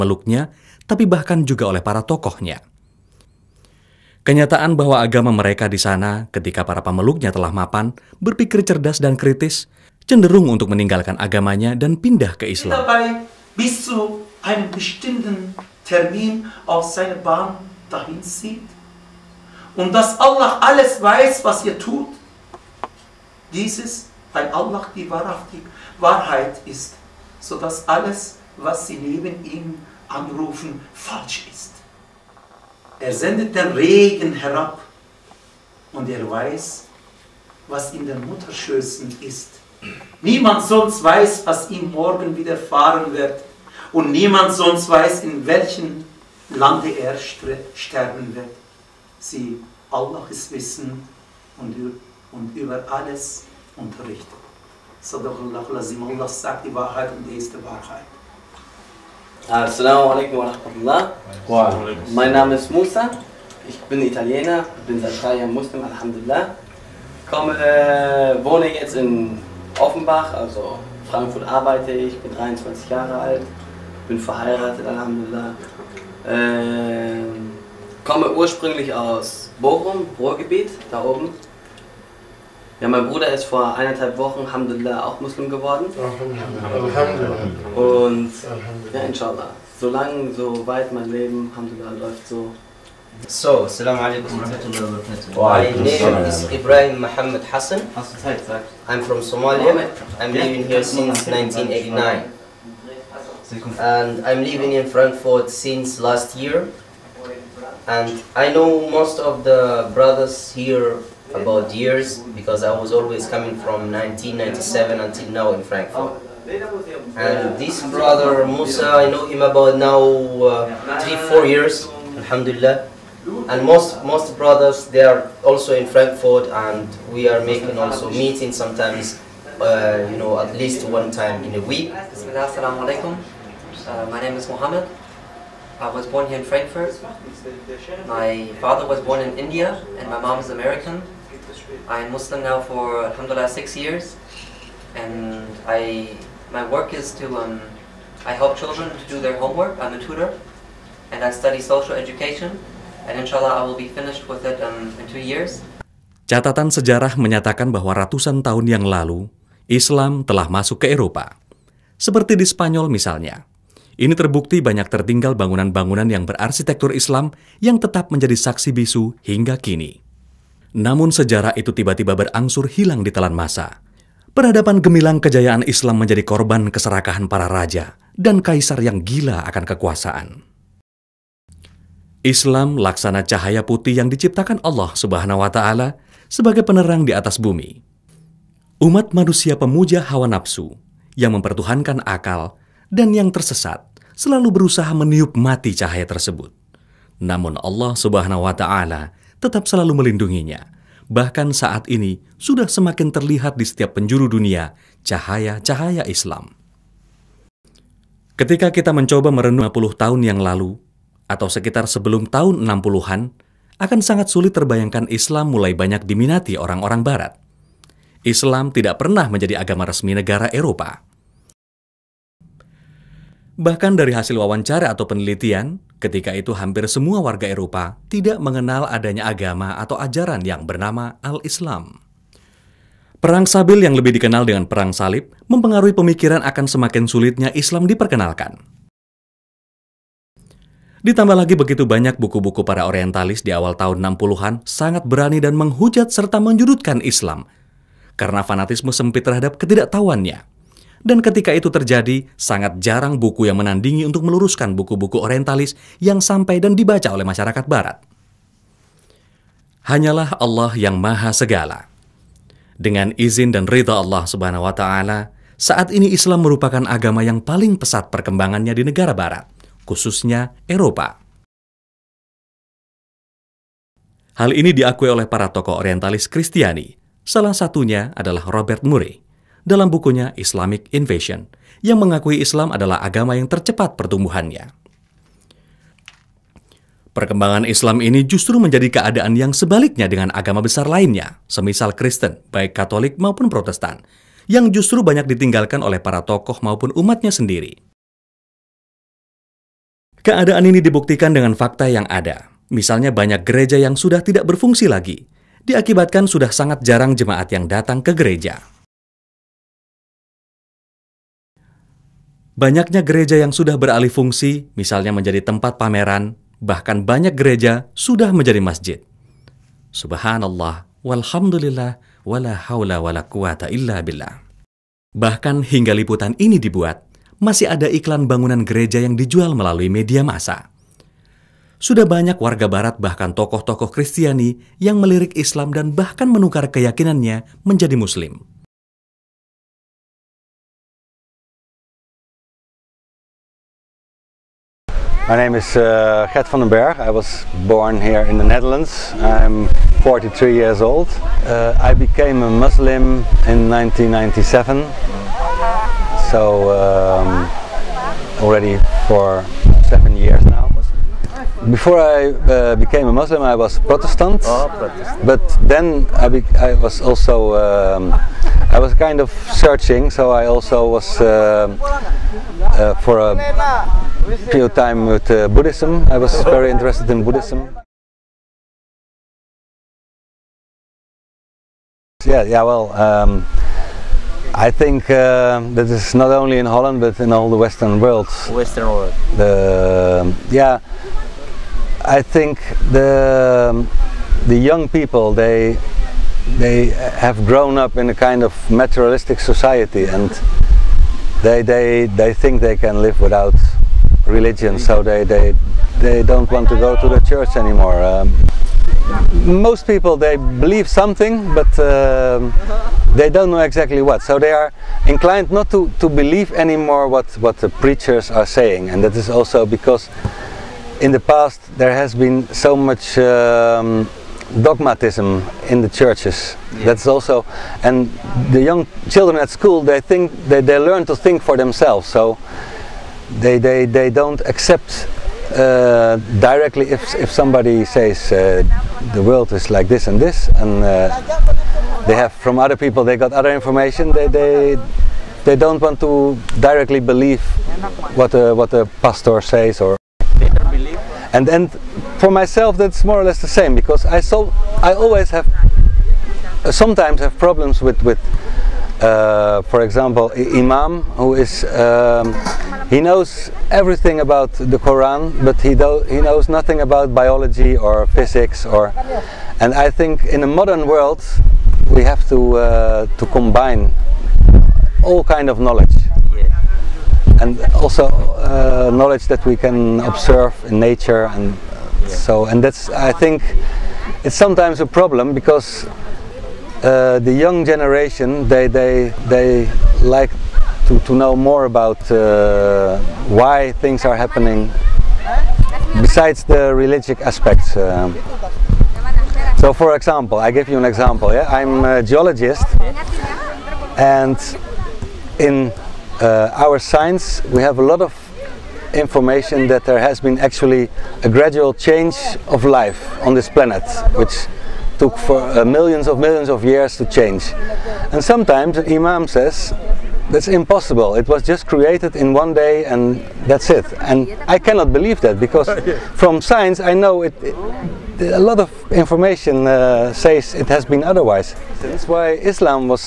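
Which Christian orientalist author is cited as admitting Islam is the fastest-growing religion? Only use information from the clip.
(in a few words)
Robert Murray.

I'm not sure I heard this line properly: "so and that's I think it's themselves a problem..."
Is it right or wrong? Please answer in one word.
wrong.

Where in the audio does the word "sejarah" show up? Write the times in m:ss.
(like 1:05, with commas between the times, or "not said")
2:36, 2:51.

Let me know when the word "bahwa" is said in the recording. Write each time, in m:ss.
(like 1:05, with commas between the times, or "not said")
0:04, 2:37.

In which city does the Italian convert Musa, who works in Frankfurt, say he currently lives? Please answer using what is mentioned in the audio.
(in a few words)
Offenbach.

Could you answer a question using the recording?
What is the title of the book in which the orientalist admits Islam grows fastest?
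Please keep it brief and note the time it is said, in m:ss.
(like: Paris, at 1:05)
Islamic Invasion, at 4:40.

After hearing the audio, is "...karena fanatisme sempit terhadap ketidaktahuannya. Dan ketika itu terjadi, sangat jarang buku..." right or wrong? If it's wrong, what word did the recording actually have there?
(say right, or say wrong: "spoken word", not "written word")
right.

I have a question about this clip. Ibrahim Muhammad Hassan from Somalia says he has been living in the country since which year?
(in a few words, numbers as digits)
1989.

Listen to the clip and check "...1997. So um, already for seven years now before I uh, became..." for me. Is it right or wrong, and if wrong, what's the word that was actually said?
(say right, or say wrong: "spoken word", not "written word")
right.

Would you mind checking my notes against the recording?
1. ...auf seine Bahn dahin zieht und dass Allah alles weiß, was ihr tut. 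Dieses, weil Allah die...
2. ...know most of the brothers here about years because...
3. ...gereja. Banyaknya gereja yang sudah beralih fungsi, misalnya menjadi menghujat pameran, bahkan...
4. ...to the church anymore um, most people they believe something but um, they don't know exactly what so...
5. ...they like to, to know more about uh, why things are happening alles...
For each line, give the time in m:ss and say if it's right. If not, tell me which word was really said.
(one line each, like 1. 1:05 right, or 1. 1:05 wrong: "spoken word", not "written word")
1. 0:16 right
2. 1:48 right
3. 5:08 wrong: "tempat", not "menghujat"
4. 6:46 right
5. 8:09 wrong: "besides", not "alles".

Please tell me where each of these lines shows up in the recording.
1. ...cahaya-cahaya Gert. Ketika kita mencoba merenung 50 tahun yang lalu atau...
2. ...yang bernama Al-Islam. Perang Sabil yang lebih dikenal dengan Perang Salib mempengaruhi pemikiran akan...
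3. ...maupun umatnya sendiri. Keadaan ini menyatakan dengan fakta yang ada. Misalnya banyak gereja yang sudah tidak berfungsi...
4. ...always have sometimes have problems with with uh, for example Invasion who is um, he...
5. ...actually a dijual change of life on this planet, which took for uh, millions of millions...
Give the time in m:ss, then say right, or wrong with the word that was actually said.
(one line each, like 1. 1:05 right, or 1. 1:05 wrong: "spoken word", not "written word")
1. 3:25 wrong: "Islam", not "Gert"
2. 3:50 right
3. 4:56 wrong: "dibuktikan", not "menyatakan"
4. 7:34 wrong: "Imam", not "Invasion"
5. 8:30 wrong: "gradual", not "dijual".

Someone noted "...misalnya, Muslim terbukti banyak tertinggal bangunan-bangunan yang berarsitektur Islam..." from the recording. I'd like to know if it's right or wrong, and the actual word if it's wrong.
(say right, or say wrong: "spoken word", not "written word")
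wrong: "Ini", not "Muslim".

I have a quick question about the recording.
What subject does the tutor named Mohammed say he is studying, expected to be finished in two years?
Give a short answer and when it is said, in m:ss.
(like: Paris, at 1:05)
social education, at 2:31.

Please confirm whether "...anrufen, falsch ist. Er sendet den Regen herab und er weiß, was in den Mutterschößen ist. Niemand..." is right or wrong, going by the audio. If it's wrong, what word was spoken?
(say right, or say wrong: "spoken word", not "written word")
right.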